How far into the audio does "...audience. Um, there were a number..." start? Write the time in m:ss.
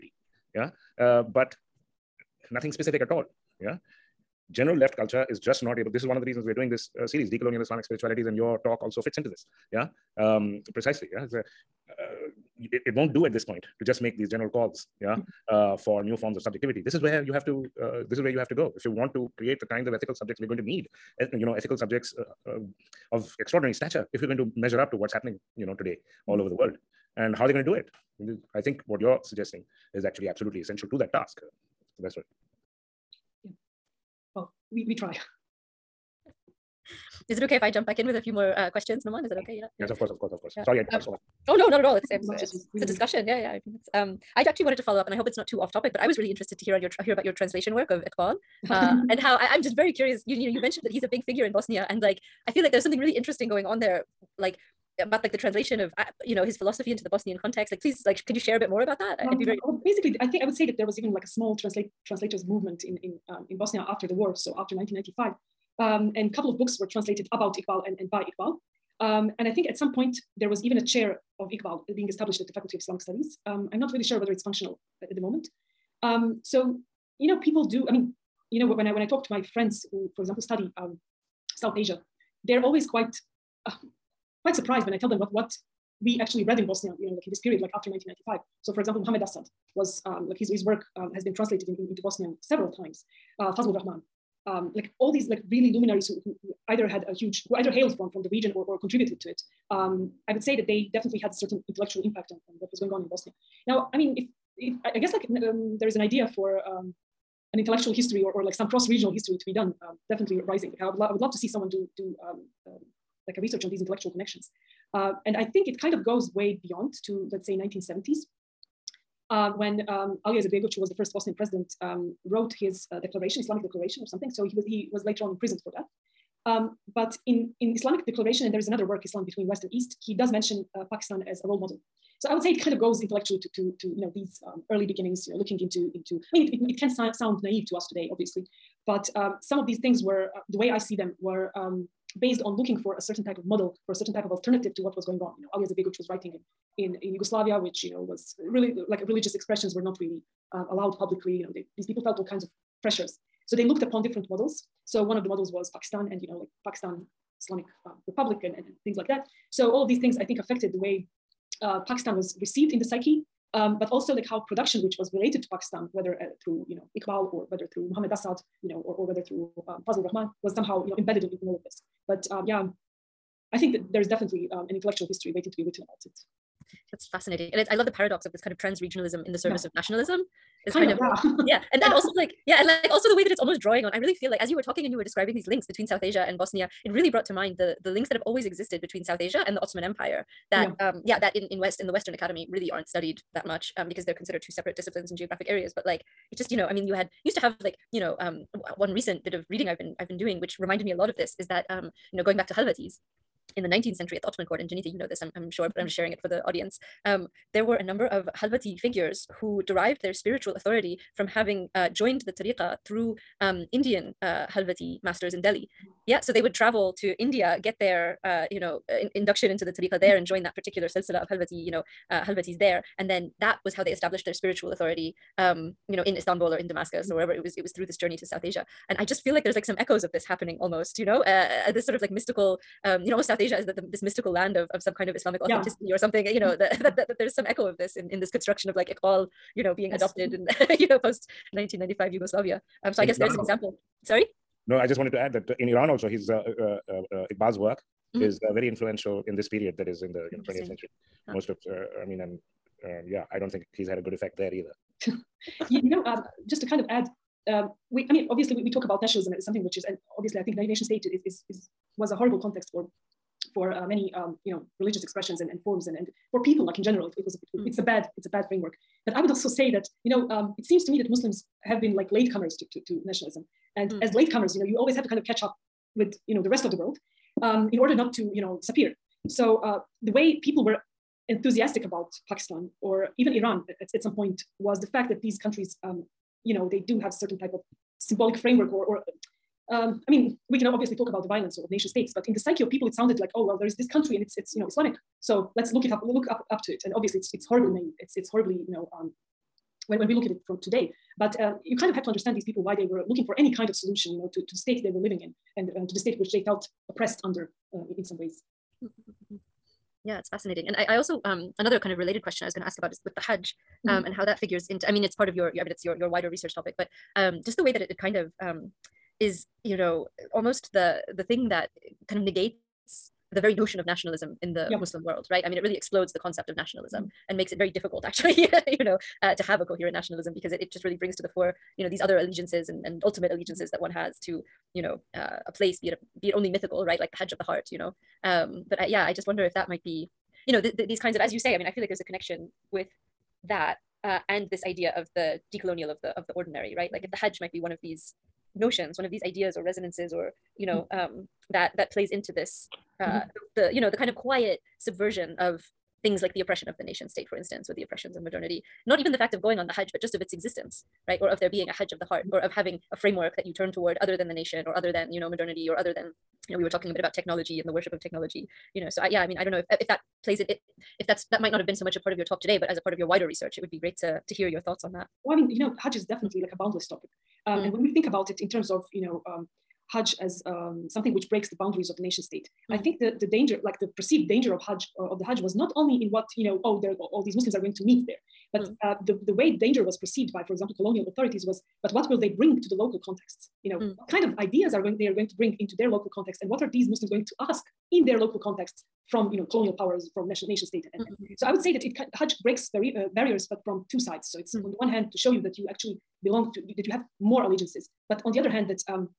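3:26.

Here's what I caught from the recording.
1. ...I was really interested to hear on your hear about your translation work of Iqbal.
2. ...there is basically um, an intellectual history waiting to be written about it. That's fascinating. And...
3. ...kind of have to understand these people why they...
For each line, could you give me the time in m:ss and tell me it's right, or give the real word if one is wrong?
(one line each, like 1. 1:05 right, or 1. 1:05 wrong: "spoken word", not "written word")
1. 0:45 right
2. 2:53 wrong: "definitely", not "basically"
3. 5:01 right.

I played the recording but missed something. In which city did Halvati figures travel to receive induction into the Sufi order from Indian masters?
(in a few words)
Delhi.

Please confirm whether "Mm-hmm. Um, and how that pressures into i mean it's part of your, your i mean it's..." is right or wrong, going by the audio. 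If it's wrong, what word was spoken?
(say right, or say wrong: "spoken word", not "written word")
wrong: "figures", not "pressures".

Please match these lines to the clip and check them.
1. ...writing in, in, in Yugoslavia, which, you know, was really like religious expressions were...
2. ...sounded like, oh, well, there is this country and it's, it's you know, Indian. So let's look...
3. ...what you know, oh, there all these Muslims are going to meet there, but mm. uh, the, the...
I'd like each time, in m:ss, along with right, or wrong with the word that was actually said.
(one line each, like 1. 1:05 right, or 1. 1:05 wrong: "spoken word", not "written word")
1. 2:26 right
2. 4:52 wrong: "Islamic", not "Indian"
3. 6:26 right.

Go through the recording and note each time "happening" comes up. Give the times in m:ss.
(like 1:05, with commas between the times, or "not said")
0:25, 3:50.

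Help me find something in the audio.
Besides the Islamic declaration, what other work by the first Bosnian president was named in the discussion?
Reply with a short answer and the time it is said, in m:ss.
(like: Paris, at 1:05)
Islam Between West and East, at 2:09.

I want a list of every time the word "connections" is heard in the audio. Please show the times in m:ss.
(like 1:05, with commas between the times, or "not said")
1:54, 5:42.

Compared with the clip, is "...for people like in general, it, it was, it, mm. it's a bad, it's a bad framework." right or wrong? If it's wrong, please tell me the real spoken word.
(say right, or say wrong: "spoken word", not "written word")
right.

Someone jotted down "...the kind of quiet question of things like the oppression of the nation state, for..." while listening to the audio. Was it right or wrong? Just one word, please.
wrong.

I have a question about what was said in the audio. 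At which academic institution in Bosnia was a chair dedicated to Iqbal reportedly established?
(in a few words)
Faculty of Islamic Studies.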